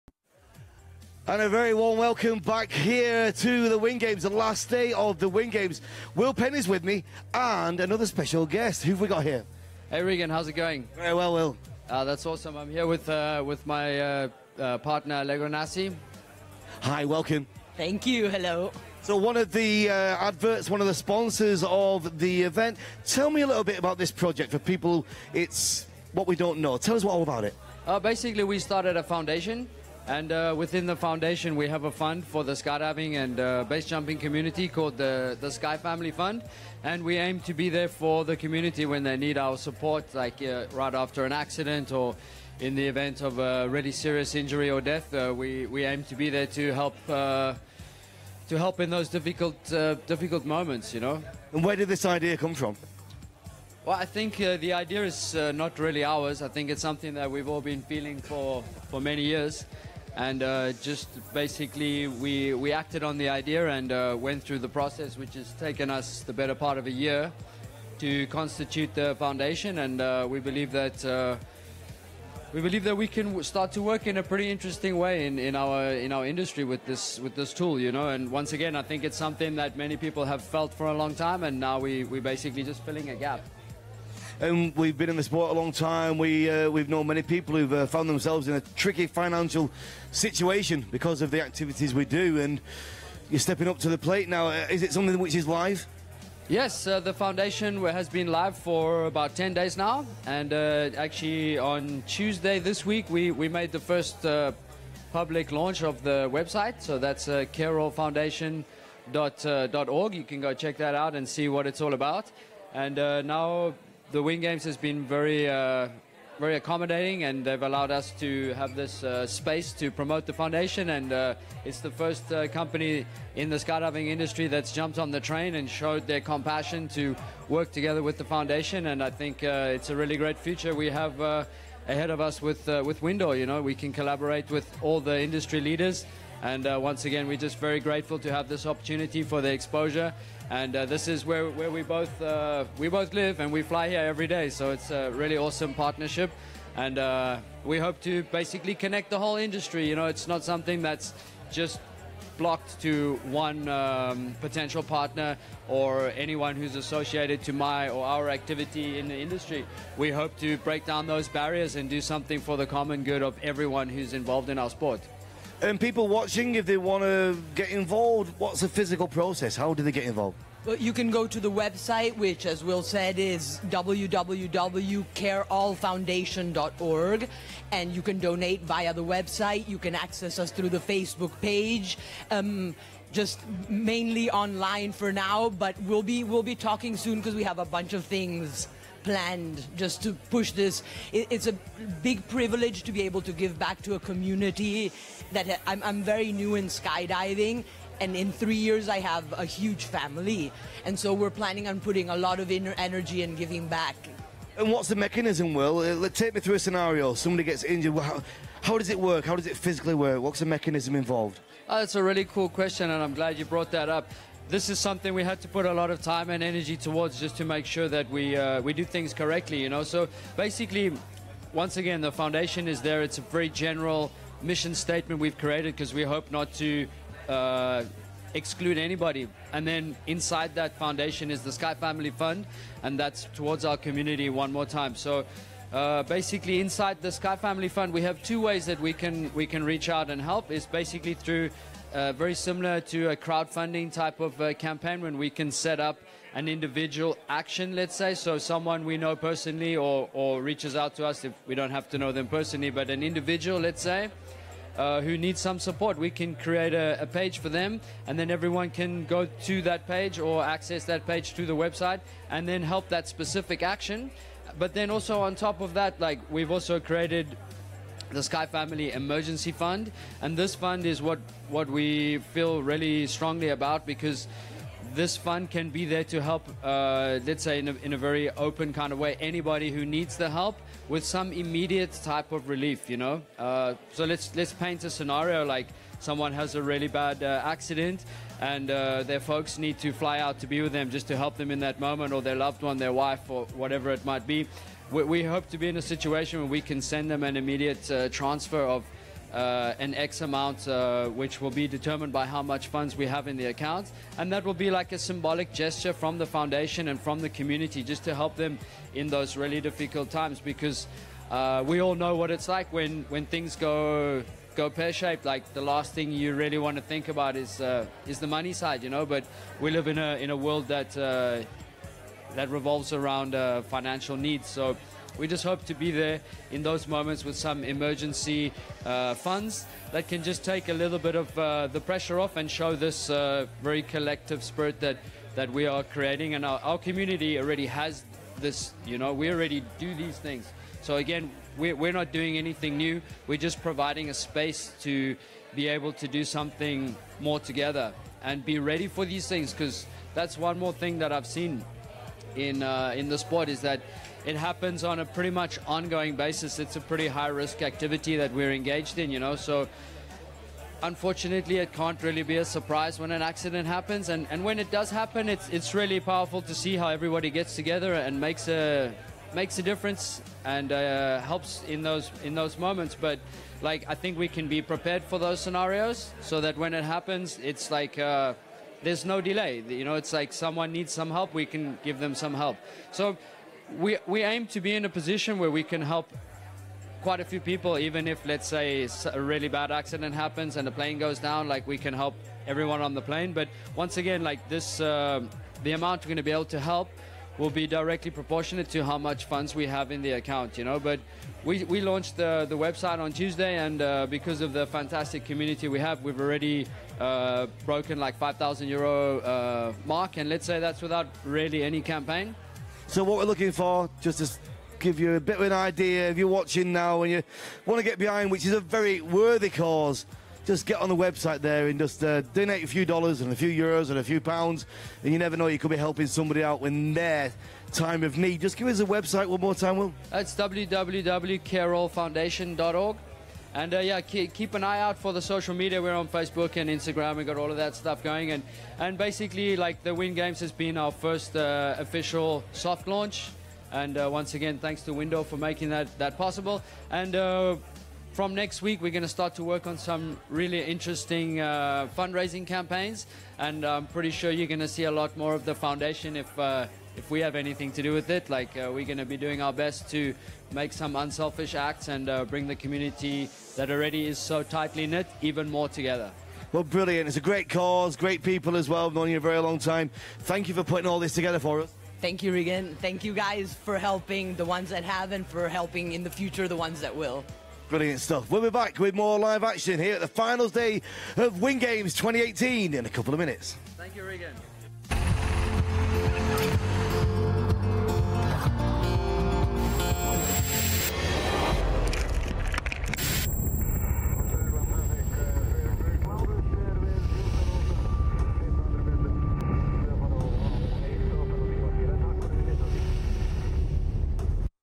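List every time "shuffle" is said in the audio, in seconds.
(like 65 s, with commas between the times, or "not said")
not said.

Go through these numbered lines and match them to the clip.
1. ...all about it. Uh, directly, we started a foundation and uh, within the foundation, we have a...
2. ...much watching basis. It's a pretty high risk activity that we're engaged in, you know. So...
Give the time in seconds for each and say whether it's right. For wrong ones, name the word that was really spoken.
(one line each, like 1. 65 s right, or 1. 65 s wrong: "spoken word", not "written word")
1. 27 s wrong: "basically", not "directly"
2. 355 s wrong: "ongoing", not "watching".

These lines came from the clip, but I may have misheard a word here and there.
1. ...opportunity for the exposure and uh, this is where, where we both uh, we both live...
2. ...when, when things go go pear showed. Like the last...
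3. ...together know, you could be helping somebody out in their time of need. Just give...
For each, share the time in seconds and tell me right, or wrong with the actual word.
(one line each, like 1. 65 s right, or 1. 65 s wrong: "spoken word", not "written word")
1. 138 s right
2. 312 s wrong: "shaped", not "showed"
3. 425 s wrong: "never", not "together".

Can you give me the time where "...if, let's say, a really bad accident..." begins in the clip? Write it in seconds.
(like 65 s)
388 s.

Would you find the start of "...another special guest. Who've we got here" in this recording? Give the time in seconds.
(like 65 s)
7 s.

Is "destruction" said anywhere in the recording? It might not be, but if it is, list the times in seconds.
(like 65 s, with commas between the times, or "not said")
not said.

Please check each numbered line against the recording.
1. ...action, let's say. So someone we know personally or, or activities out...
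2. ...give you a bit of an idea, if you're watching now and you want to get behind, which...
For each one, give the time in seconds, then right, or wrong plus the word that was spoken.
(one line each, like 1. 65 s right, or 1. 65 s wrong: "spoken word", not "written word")
1. 247 s wrong: "reaches", not "activities"
2. 414 s right.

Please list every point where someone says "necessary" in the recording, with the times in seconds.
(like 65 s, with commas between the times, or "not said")
not said.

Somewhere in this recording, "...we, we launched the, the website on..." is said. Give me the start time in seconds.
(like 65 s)
401 s.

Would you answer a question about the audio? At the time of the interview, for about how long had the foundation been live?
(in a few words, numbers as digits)
about 10 days.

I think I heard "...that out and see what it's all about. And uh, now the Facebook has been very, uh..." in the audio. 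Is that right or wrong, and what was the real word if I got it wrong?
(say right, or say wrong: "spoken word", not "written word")
wrong: "WindGames", not "Facebook".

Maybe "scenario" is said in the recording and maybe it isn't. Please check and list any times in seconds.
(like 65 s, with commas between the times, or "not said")
206 s, 284 s, 375 s.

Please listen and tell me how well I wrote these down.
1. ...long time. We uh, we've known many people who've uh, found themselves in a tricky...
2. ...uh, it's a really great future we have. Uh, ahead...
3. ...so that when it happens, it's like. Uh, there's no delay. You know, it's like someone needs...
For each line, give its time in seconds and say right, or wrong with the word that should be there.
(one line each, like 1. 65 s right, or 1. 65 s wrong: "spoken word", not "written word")
1. 85 s right
2. 129 s right
3. 376 s right.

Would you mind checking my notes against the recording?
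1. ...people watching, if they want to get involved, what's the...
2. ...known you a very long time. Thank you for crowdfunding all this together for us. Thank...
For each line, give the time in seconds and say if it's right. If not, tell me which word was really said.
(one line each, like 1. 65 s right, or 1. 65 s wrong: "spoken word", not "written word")
1. 165 s right
2. 468 s wrong: "putting", not "crowdfunding".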